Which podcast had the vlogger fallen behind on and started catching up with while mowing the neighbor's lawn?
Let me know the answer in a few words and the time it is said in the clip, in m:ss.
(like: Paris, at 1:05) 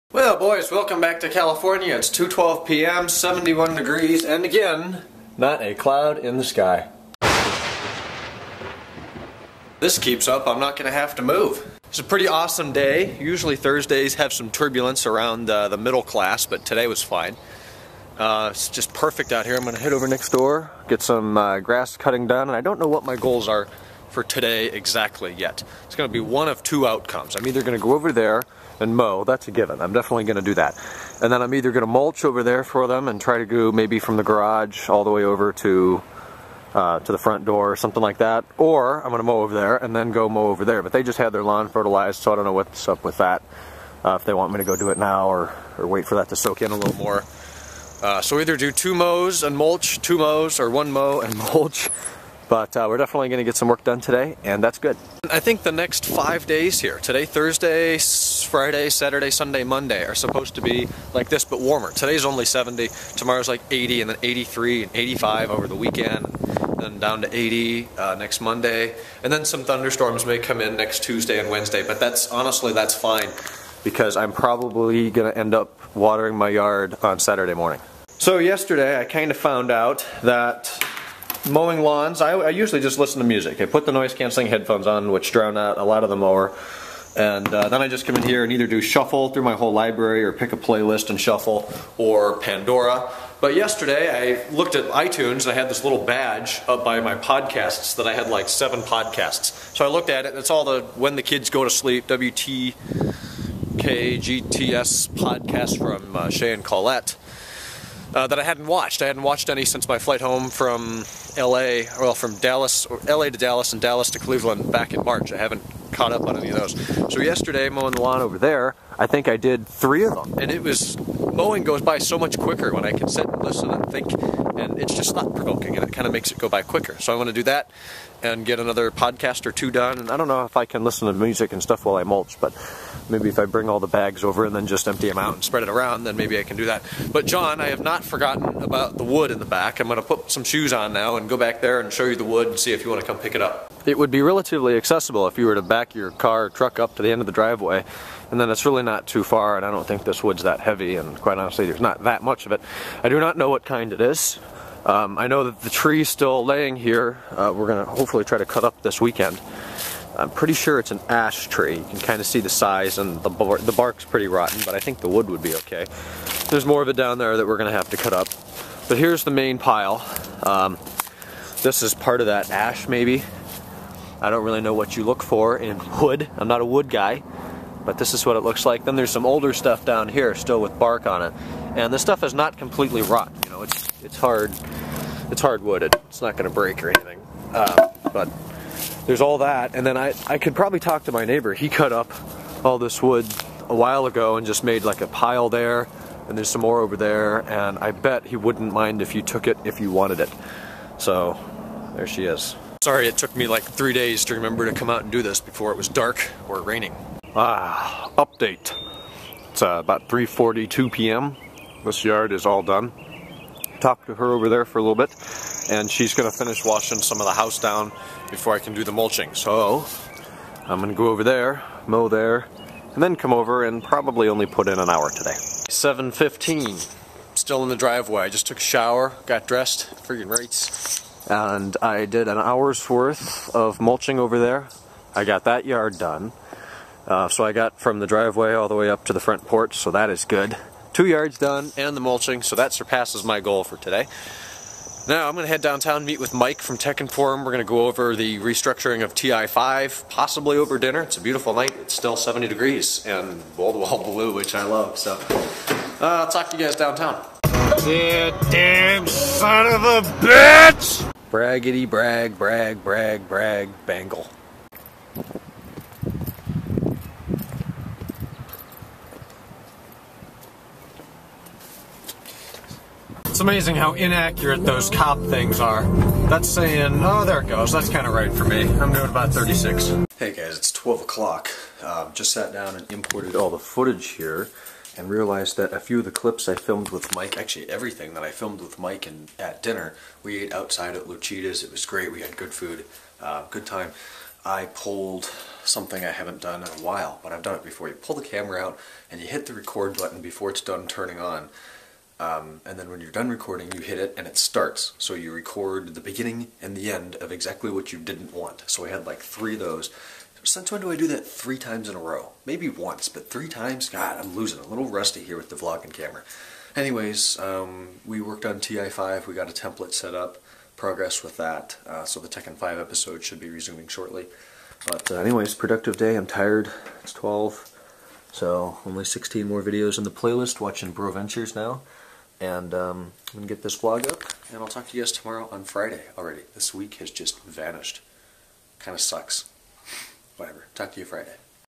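When the Kids Go to Sleep, at 1:40.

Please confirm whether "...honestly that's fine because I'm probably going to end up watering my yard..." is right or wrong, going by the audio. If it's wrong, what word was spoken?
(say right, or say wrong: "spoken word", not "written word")
right.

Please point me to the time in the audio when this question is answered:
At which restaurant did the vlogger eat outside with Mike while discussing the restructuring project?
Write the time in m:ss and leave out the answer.
4:51.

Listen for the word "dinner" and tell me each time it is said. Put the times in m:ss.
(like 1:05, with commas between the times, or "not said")
4:10, 4:49.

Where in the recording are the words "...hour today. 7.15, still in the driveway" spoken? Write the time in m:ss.
3:44.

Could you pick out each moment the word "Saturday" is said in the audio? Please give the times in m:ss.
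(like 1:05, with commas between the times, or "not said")
0:58, 1:17.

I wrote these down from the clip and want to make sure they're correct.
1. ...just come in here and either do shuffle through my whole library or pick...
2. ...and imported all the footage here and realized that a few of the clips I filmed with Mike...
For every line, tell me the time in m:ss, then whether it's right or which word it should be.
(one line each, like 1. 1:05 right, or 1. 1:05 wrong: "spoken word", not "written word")
1. 1:27 right
2. 4:42 right.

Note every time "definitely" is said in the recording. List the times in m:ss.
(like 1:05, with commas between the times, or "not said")
0:29, 0:52.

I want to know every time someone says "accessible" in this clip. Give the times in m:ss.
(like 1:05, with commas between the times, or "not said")
2:24.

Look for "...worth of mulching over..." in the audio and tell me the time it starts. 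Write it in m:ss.
3:52.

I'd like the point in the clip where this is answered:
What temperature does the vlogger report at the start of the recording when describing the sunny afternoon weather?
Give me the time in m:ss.
0:03.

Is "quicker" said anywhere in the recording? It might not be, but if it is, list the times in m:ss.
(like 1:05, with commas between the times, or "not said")
2:02, 2:06.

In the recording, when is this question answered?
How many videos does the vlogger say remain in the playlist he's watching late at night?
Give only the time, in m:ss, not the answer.
5:29.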